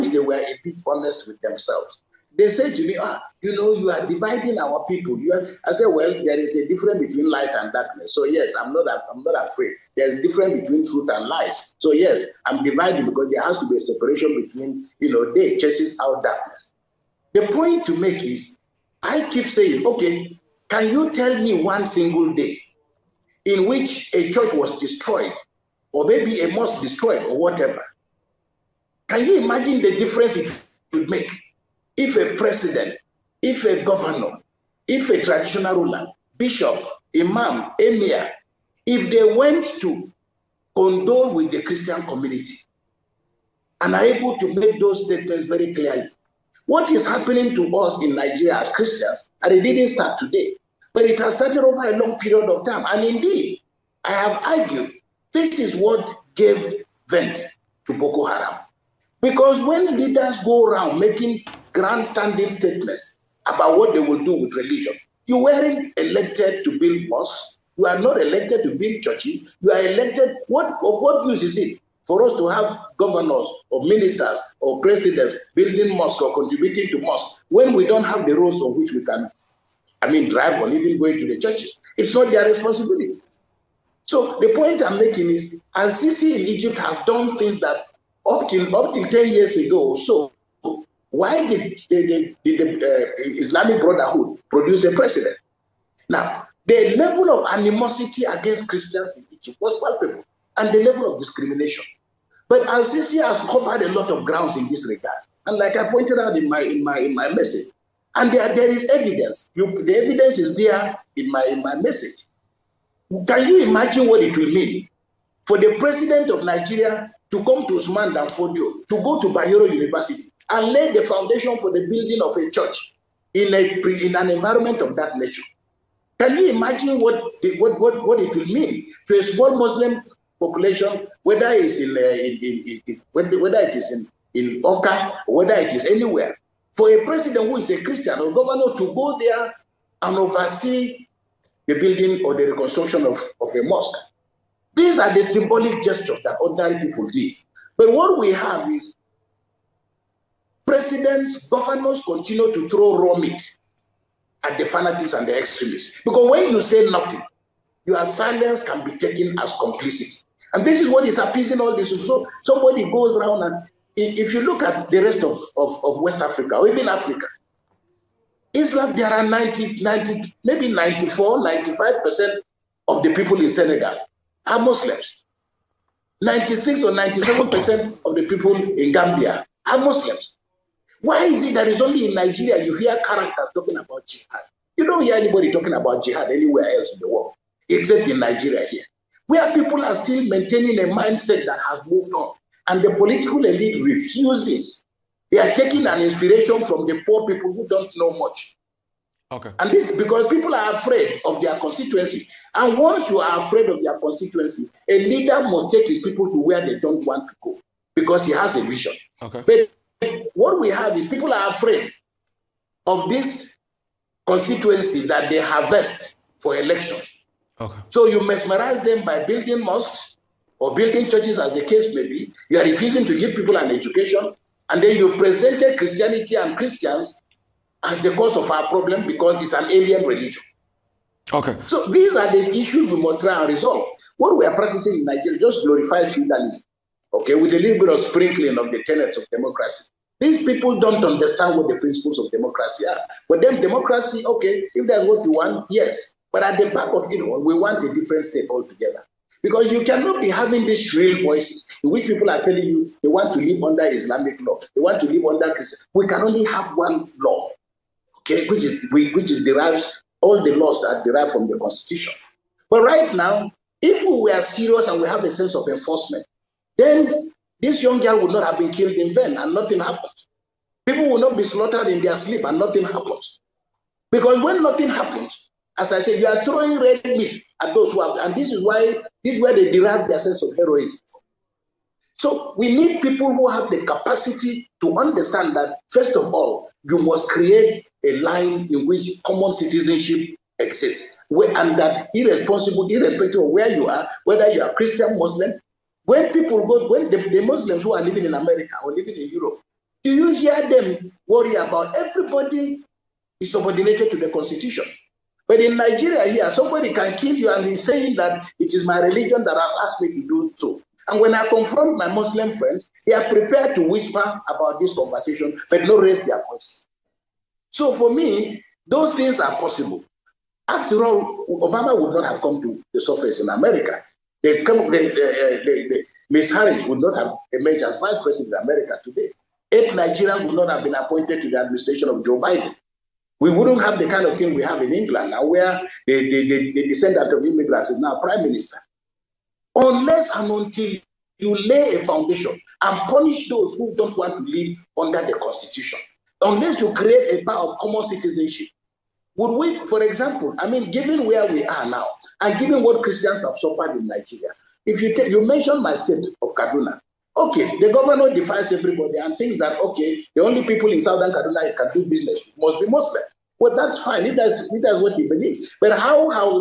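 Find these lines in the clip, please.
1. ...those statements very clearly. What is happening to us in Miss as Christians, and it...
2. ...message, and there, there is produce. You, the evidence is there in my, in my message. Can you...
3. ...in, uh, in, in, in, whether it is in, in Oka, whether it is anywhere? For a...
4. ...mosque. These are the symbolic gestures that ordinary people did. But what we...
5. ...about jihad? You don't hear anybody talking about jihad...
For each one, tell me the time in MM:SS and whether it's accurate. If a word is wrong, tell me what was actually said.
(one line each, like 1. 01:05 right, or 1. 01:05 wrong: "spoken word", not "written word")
1. 00:44 wrong: "Nigeria", not "Miss"
2. 01:47 wrong: "evidence", not "produce"
3. 02:11 right
4. 02:23 right
5. 03:03 right.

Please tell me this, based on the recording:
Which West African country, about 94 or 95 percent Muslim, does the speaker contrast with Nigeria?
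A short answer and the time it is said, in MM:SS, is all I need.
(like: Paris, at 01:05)
Senegal, at 02:53.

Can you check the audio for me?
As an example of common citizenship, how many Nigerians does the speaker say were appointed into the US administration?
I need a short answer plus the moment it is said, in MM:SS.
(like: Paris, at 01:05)
8, at 05:29.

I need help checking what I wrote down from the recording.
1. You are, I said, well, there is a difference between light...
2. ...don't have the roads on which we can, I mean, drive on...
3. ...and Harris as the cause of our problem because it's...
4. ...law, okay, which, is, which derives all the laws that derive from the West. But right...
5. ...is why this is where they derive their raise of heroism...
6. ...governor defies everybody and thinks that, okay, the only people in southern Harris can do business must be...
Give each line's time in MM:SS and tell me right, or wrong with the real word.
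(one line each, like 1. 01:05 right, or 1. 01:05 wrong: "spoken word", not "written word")
1. 00:05 right
2. 01:17 right
3. 03:46 wrong: "Christians", not "Harris"
4. 04:17 wrong: "Constitution", not "West"
5. 04:38 wrong: "sense", not "raise"
6. 05:57 wrong: "Kaduna", not "Harris".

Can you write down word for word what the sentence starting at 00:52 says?
And indeed, I have argued this is what gave vent to Boko Haram.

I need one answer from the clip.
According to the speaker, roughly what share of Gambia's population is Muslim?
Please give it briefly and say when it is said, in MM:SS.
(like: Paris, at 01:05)
96 or 97%, at 02:56.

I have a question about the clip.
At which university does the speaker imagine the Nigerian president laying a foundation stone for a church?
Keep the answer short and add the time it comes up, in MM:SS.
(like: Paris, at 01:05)
Bayero University, at 01:59.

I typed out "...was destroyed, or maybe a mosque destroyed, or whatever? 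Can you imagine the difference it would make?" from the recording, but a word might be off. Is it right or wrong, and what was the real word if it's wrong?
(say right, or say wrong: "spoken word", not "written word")
right.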